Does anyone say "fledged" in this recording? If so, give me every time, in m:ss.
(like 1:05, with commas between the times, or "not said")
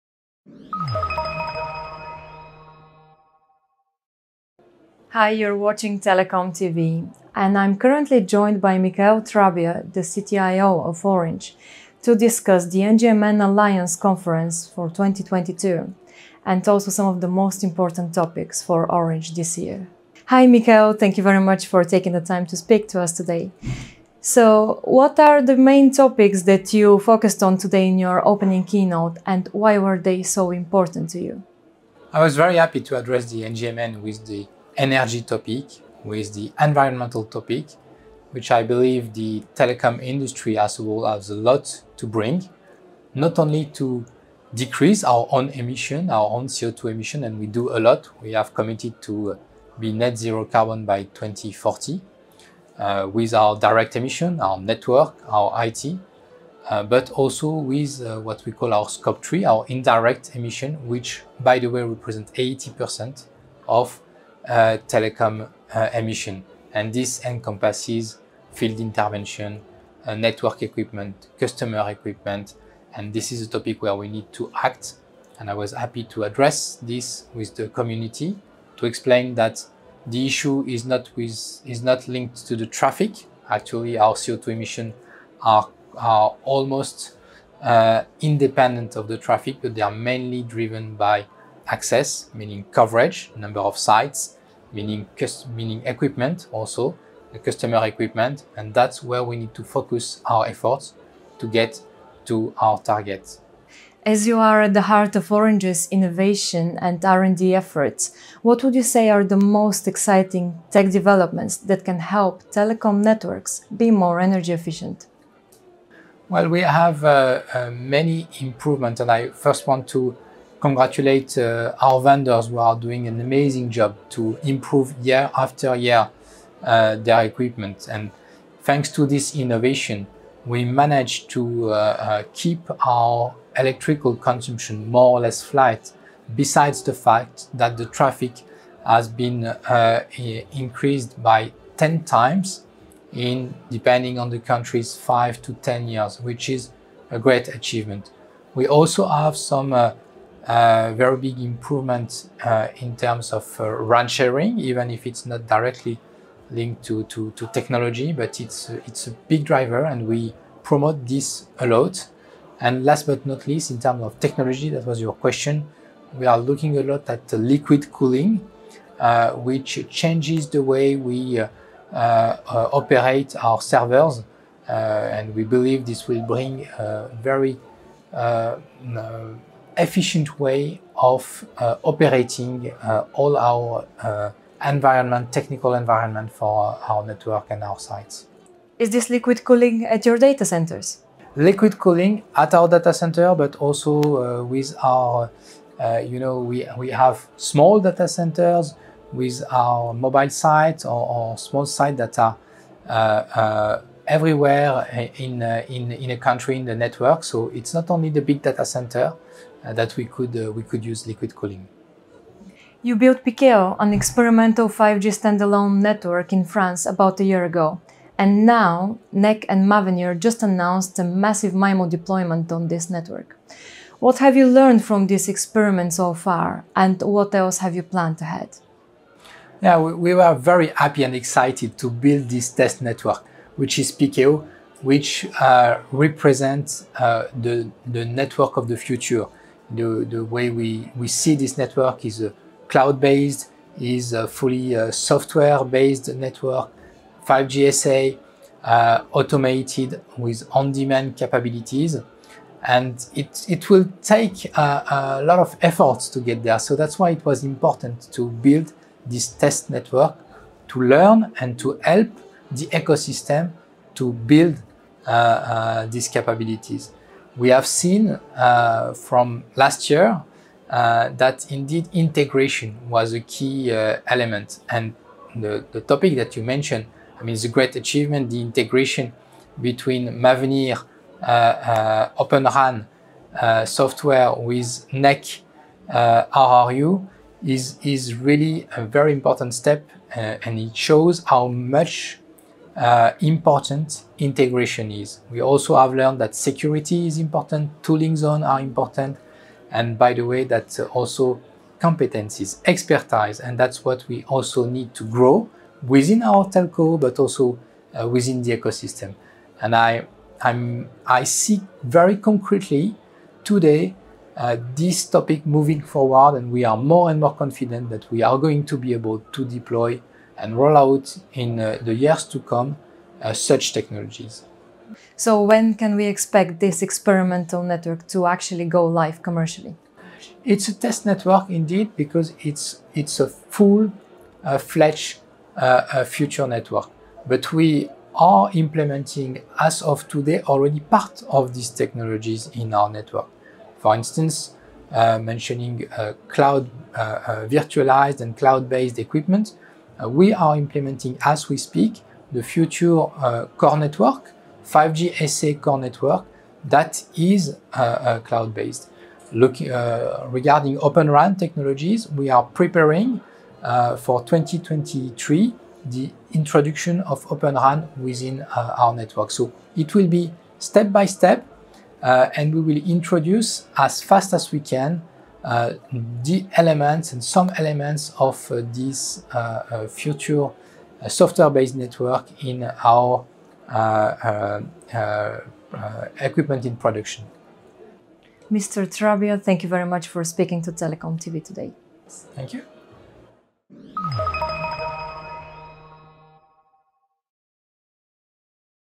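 5:33.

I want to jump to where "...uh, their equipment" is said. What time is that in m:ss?
2:06.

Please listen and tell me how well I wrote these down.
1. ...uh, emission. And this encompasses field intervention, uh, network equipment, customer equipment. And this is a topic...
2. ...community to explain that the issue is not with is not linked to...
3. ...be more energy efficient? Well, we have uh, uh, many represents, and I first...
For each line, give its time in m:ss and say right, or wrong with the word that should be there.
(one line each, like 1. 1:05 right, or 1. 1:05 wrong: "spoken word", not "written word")
1. 1:05 right
2. 1:17 right
3. 1:53 wrong: "improvements", not "represents".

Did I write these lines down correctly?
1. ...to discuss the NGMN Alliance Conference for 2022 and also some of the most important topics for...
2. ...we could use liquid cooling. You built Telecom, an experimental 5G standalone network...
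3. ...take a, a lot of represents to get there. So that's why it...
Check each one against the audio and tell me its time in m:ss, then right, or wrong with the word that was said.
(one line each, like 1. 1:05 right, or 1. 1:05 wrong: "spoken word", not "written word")
1. 0:12 right
2. 3:30 wrong: "Pikeo", not "Telecom"
3. 4:14 wrong: "efforts", not "represents".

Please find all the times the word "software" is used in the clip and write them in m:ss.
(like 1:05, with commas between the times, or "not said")
4:04, 4:43, 6:21.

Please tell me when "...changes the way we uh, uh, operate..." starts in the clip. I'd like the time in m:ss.
2:49.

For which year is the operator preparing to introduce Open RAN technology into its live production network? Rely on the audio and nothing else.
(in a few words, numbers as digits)
2023.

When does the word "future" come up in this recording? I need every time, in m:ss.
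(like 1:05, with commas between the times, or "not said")
3:58, 5:36, 5:52, 6:19.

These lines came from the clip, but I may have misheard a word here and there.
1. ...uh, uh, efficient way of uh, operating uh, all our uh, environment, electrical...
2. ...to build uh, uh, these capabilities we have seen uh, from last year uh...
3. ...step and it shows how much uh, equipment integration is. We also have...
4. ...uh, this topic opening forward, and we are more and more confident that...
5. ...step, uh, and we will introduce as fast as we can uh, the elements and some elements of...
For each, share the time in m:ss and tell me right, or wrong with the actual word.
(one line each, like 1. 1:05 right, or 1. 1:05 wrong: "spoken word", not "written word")
1. 2:58 wrong: "technical", not "electrical"
2. 4:23 right
3. 4:49 wrong: "important", not "equipment"
4. 5:14 wrong: "moving", not "opening"
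5. 6:11 right.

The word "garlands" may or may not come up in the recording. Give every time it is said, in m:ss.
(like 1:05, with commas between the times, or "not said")
not said.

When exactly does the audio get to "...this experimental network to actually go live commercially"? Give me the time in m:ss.
5:26.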